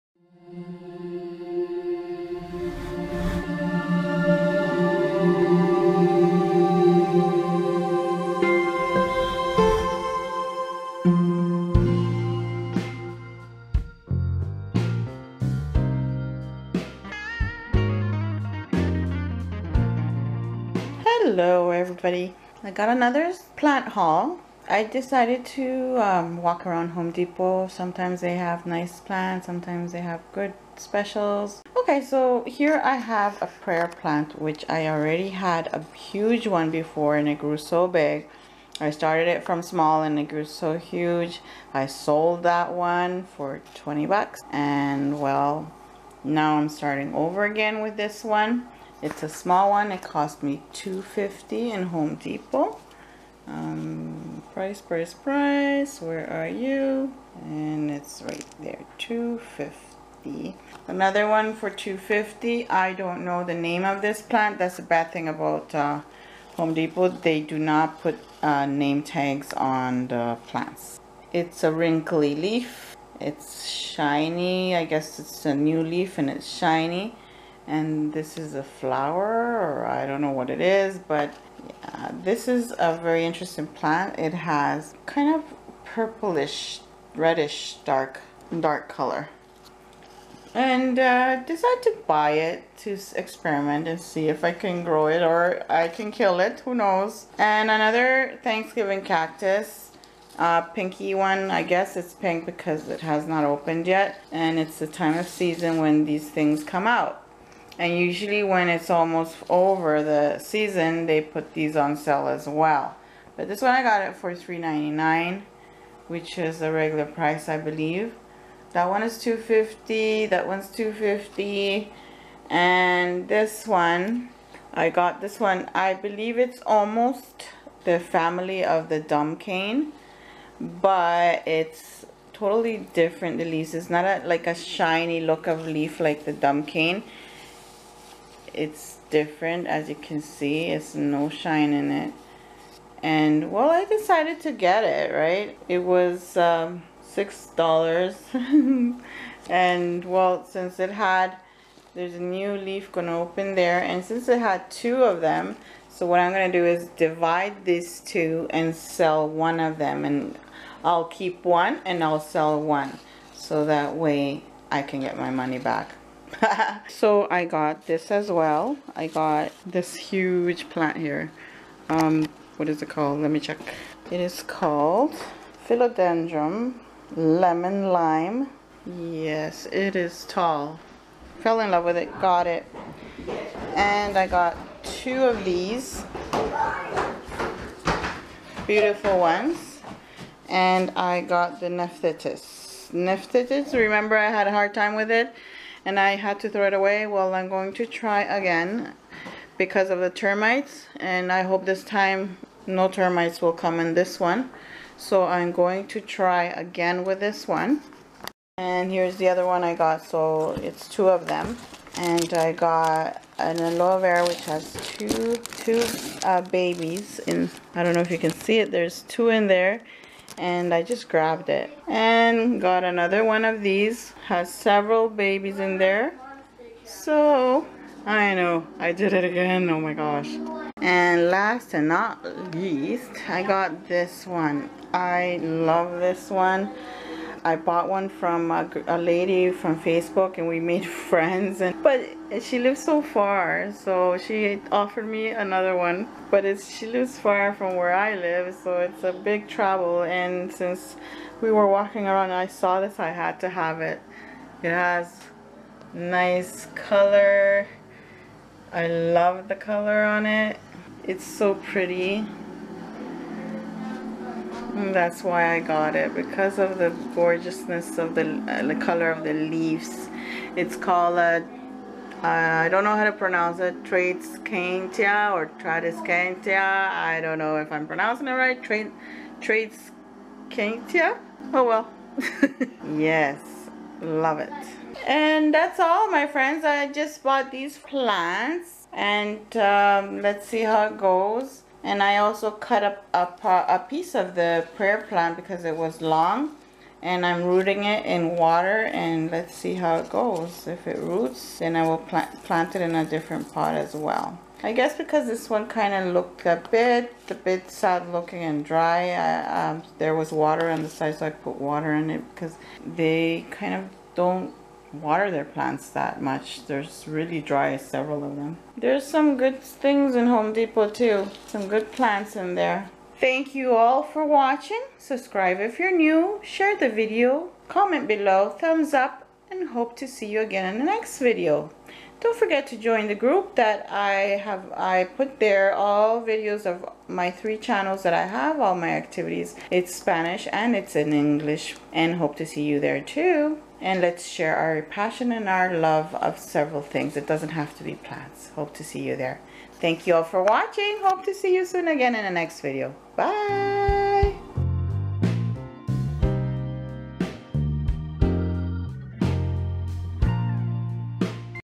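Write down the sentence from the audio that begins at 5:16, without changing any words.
They're really dry, several of them.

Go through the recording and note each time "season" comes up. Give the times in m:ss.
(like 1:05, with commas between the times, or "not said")
1:45, 1:50.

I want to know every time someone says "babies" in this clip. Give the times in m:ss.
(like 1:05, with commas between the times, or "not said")
3:36, 3:45.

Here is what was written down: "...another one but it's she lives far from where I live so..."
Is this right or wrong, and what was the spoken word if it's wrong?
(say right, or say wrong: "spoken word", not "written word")
right.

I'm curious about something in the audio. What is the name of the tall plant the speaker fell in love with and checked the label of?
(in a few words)
Philodendron lemon lime.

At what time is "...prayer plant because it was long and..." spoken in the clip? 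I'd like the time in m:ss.
4:54.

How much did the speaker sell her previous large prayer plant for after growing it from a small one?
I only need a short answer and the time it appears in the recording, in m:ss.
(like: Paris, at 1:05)
$20, at 0:43.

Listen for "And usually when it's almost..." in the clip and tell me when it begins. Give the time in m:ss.
1:47.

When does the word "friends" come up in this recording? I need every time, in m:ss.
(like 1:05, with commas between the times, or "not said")
4:01, 4:46.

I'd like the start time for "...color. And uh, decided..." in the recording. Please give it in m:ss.
1:28.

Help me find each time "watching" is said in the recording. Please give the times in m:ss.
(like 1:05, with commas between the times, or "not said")
5:24, 5:50.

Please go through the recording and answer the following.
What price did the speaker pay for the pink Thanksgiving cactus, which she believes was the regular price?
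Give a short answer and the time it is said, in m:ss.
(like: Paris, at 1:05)
$3.99, at 1:54.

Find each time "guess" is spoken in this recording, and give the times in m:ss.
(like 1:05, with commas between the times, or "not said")
1:14, 1:41, 5:04.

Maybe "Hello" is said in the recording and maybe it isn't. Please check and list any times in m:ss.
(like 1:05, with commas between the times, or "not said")
0:21.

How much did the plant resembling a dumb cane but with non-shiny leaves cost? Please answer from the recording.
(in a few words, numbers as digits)
$6.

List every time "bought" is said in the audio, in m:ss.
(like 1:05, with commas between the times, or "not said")
3:57, 4:47.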